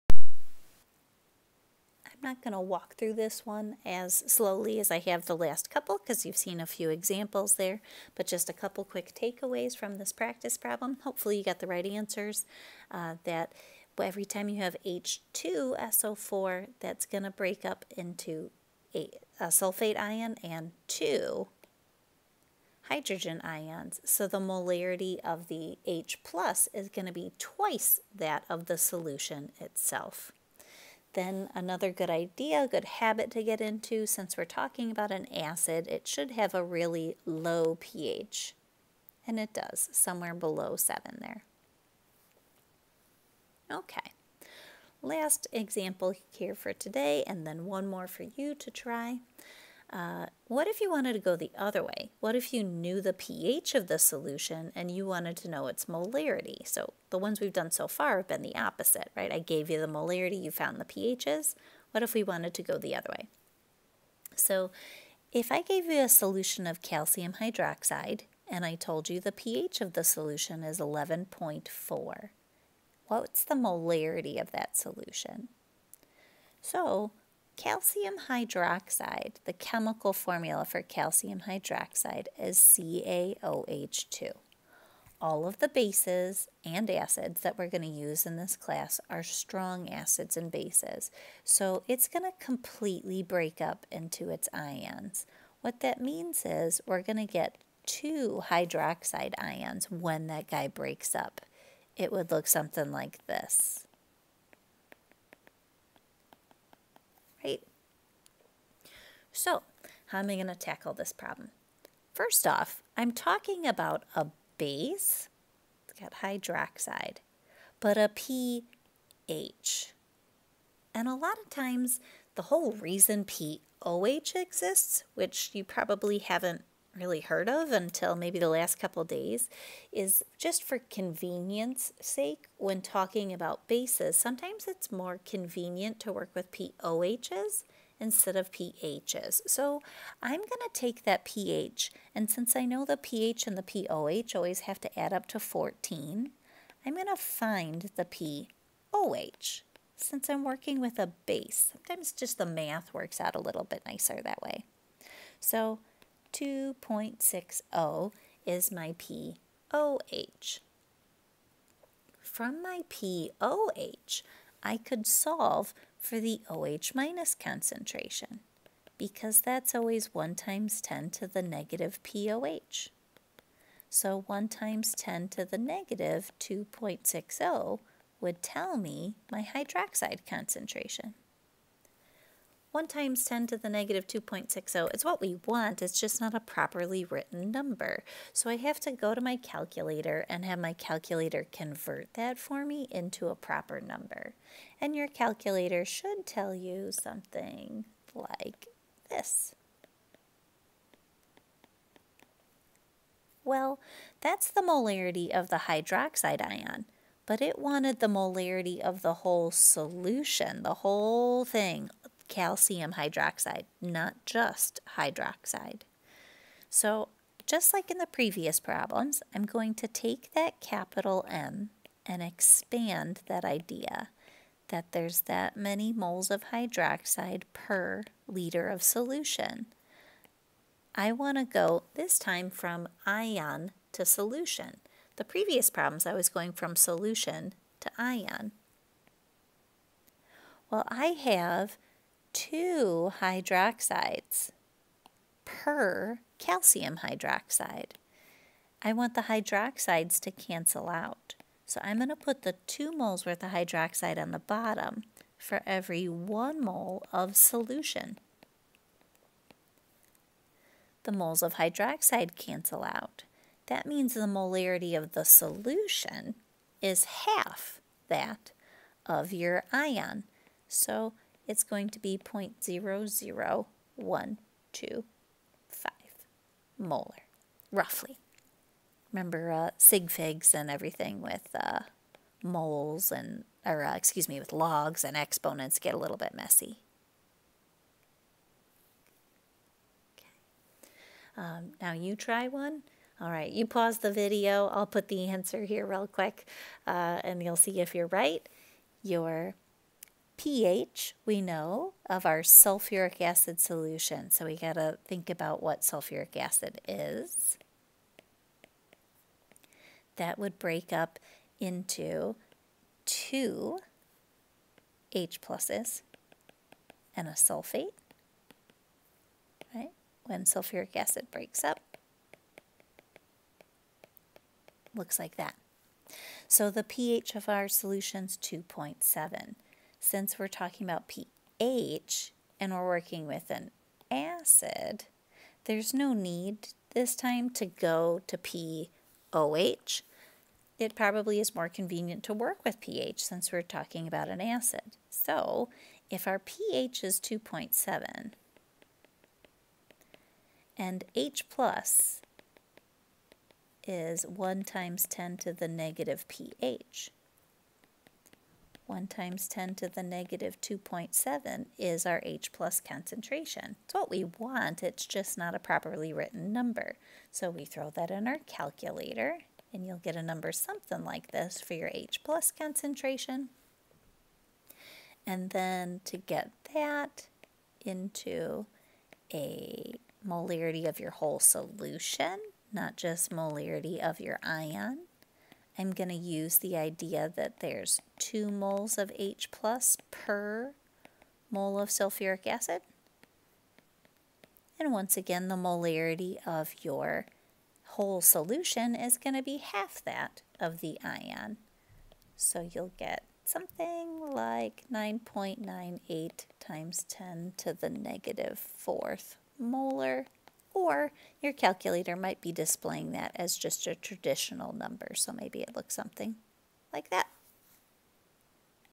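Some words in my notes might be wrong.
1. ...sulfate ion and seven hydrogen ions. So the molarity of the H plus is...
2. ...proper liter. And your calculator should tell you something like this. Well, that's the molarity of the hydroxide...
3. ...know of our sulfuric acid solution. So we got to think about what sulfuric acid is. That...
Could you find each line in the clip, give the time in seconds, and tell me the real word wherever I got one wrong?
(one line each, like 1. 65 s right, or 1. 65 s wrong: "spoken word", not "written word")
1. 19 s wrong: "two", not "seven"
2. 193 s wrong: "number", not "liter"
3. 301 s right.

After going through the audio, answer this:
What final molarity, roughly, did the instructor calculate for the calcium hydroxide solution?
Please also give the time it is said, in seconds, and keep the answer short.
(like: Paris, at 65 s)
0.00125 molar, at 272 s.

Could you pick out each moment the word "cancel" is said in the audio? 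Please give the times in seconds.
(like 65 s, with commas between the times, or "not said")
250 s, 262 s.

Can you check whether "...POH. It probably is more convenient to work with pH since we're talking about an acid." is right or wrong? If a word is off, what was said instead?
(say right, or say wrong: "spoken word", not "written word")
right.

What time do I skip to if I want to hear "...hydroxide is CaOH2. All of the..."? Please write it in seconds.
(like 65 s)
81 s.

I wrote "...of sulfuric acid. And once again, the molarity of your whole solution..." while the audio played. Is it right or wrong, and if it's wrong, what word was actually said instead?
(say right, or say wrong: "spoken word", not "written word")
right.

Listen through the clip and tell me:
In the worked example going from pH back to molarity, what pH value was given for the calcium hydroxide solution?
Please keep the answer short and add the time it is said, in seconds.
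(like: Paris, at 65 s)
11.4, at 70 s.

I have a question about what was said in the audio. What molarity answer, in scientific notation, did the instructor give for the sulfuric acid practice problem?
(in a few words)
9.98 x 10^-4 M.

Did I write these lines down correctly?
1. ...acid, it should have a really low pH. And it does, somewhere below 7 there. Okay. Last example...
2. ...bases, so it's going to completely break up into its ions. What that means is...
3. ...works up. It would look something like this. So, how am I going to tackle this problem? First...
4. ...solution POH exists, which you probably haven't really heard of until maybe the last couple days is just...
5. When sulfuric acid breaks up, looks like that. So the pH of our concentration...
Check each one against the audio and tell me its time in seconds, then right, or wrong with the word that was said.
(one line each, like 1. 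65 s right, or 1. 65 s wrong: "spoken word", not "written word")
1. 35 s right
2. 90 s right
3. 100 s wrong: "breaks", not "works"
4. 122 s wrong: "reason", not "solution"
5. 320 s wrong: "solution", not "concentration".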